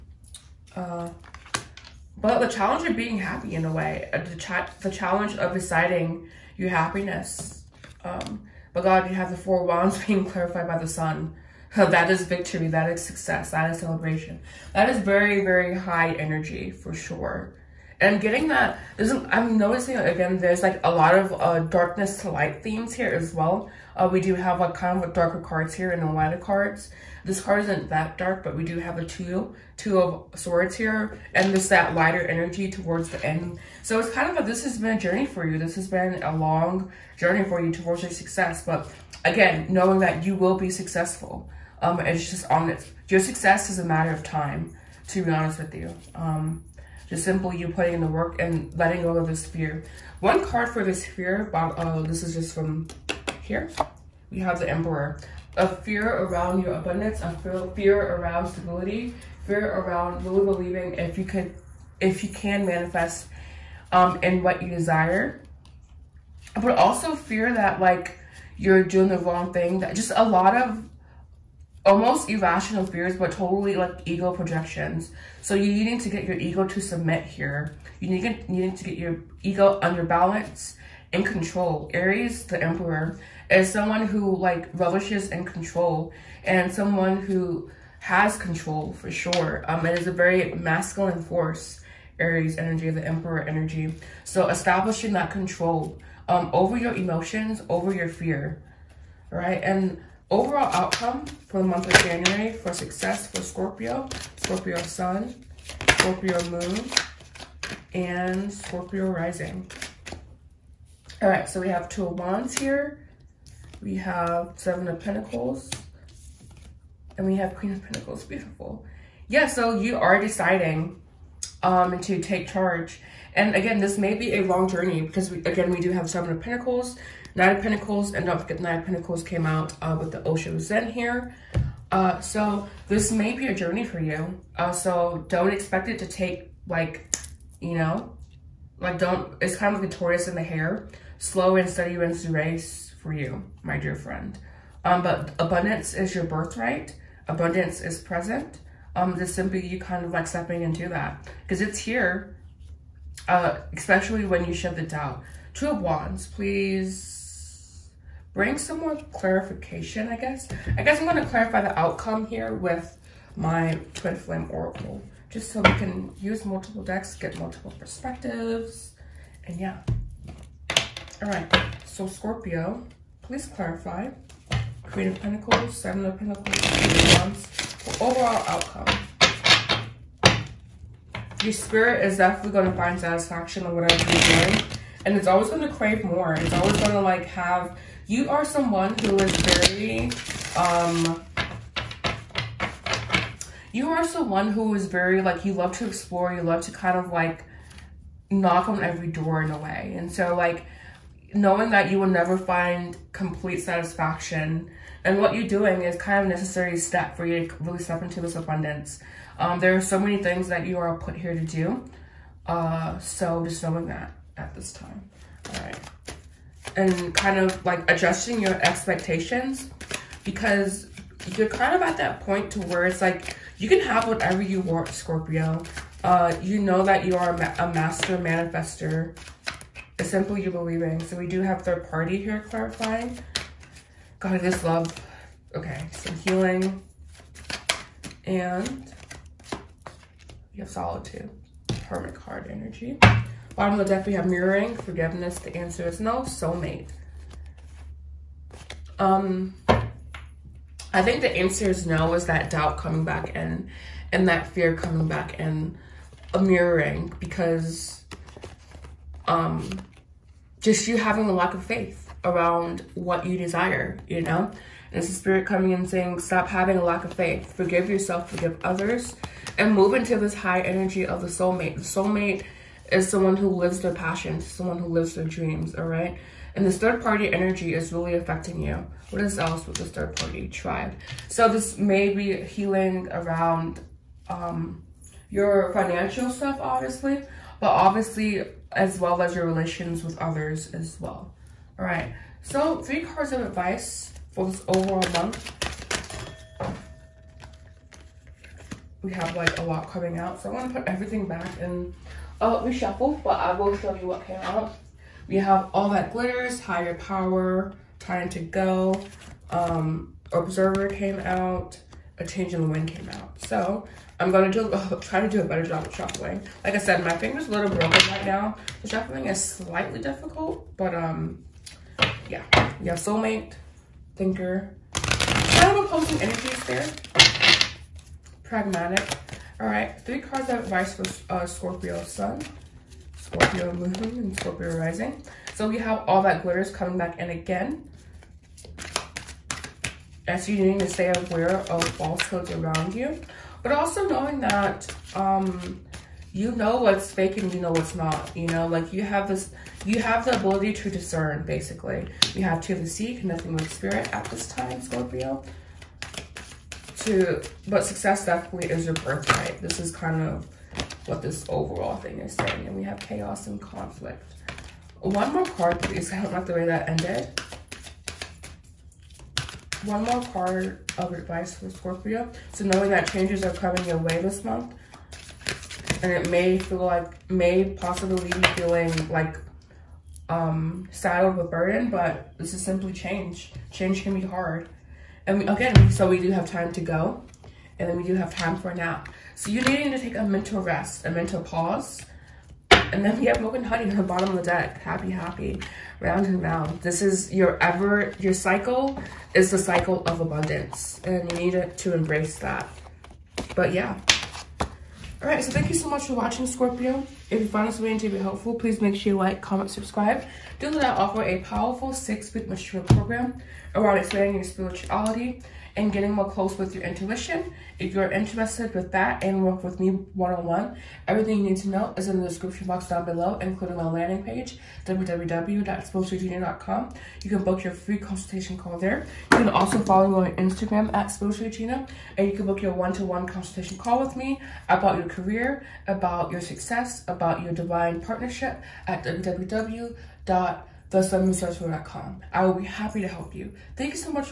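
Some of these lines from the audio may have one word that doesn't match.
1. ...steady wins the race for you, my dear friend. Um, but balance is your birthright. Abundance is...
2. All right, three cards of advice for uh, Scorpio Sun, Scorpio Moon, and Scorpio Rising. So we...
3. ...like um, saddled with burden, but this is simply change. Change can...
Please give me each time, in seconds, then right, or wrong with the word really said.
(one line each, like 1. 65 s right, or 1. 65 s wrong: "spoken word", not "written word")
1. 141 s wrong: "abundance", not "balance"
2. 329 s right
3. 379 s right.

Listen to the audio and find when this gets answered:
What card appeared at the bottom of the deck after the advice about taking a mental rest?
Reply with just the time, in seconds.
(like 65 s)
393 s.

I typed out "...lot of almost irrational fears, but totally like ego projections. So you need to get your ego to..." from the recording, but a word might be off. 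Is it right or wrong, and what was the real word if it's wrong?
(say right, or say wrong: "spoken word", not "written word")
right.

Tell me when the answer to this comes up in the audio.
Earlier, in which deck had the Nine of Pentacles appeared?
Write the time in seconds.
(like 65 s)
130 s.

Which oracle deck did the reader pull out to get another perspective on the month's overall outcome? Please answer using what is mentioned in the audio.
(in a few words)
Twin Flame Oracle.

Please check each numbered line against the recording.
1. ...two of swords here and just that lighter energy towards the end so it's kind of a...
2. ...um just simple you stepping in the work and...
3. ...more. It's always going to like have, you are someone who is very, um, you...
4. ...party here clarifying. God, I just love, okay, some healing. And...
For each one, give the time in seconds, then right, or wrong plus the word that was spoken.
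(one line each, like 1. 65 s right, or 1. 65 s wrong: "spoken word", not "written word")
1. 29 s right
2. 46 s wrong: "putting", not "stepping"
3. 186 s right
4. 231 s right.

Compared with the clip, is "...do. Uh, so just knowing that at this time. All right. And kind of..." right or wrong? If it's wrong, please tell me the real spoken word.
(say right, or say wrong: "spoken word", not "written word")
right.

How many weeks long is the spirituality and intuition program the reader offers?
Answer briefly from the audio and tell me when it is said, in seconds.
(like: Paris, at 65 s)
6, at 411 s.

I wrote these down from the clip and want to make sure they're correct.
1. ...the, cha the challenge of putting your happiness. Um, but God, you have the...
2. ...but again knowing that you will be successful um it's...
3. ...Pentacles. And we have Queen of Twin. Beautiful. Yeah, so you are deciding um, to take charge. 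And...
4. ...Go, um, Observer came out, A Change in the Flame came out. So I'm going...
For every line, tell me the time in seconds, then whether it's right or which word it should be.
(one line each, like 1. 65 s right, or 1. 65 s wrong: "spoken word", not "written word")
1. 4 s wrong: "deciding", not "putting"
2. 38 s right
3. 114 s wrong: "Pentacles", not "Twin"
4. 308 s wrong: "Wind", not "Flame".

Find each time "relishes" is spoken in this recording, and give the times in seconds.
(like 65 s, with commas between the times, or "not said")
84 s.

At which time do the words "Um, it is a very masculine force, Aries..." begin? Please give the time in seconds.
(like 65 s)
89 s.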